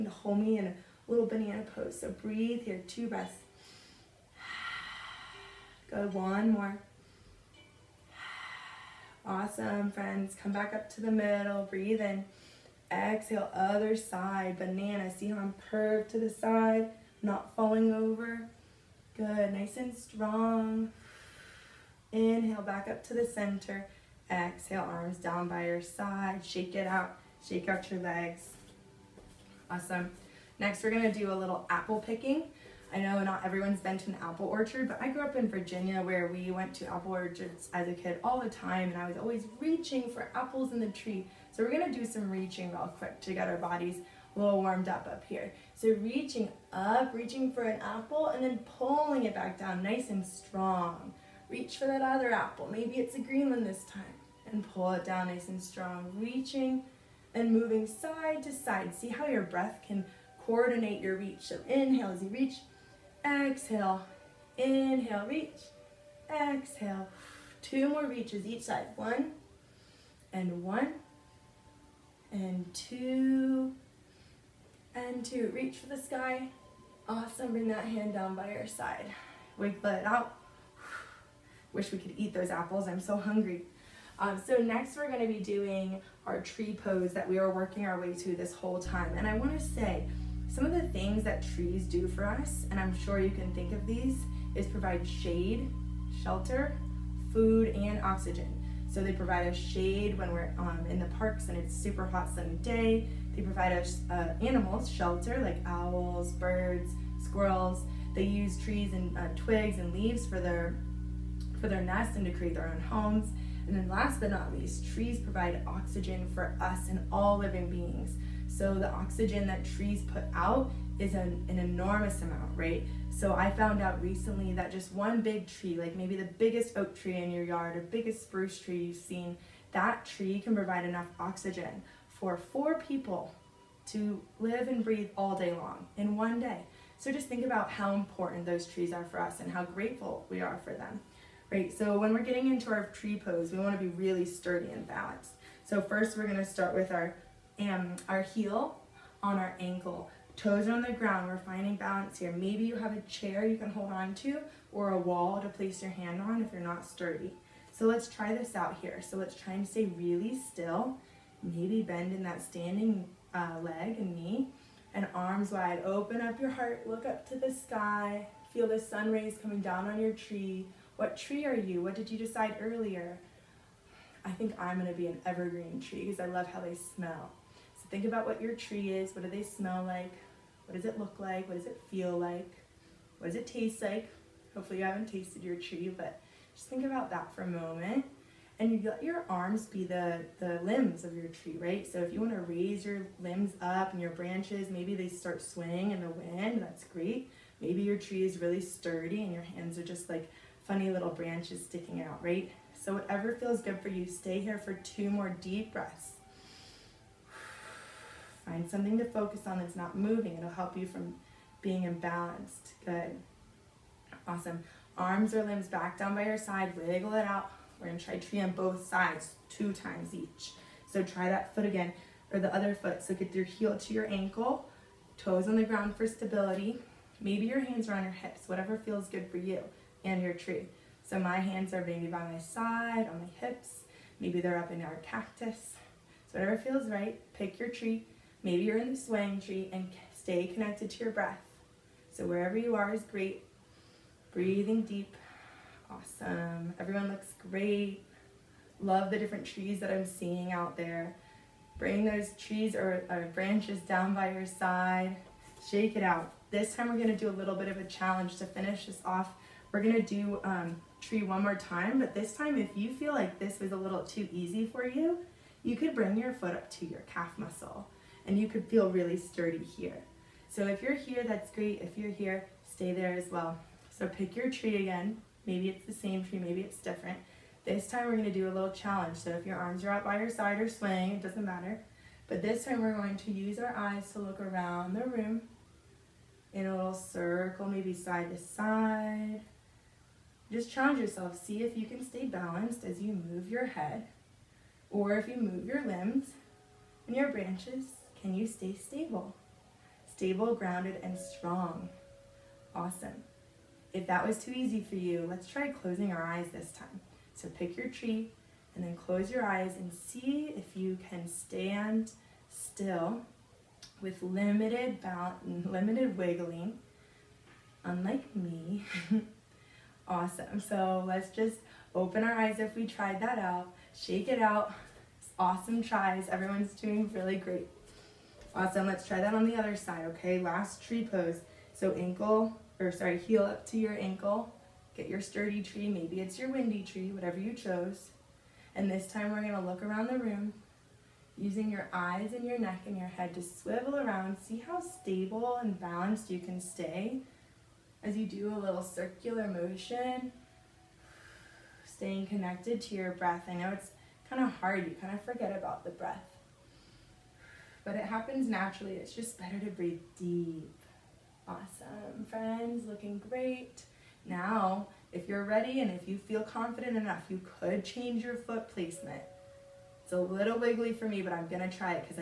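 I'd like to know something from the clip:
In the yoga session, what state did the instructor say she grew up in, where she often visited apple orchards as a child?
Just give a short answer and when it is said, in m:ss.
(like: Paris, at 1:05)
Virginia, at 0:35.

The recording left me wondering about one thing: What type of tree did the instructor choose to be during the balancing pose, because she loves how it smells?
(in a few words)
Evergreen.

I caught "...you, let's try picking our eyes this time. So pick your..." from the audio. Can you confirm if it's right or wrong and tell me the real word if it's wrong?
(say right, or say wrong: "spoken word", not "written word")
wrong: "closing", not "picking".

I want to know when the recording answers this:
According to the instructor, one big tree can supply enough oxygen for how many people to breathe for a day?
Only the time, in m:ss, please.
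2:12.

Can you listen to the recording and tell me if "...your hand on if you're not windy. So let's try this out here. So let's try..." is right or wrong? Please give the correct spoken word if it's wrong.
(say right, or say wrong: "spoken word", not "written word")
wrong: "sturdy", not "windy".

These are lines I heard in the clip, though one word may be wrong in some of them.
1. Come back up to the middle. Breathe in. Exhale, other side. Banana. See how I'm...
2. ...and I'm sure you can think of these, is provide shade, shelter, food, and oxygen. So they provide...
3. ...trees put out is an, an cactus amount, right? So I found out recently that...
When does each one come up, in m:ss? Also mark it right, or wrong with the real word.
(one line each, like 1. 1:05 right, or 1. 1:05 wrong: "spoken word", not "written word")
1. 0:10 right
2. 1:32 right
3. 1:59 wrong: "enormous", not "cactus".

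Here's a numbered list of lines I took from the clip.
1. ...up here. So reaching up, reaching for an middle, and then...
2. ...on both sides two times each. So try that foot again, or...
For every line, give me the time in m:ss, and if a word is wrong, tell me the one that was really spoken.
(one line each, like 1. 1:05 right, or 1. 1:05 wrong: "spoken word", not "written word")
1. 0:45 wrong: "apple", not "middle"
2. 3:38 right.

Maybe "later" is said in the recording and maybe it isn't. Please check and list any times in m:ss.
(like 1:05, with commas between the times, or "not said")
not said.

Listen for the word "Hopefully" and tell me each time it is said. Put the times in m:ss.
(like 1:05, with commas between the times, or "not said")
3:04.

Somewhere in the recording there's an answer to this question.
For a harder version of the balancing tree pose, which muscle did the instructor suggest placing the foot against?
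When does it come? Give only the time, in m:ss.
4:27.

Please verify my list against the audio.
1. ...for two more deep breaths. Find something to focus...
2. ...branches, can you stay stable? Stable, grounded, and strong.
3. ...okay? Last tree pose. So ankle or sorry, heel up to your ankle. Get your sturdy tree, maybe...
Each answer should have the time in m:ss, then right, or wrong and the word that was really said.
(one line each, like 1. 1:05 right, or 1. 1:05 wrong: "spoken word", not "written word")
1. 3:24 right
2. 4:57 right
3. 5:30 right.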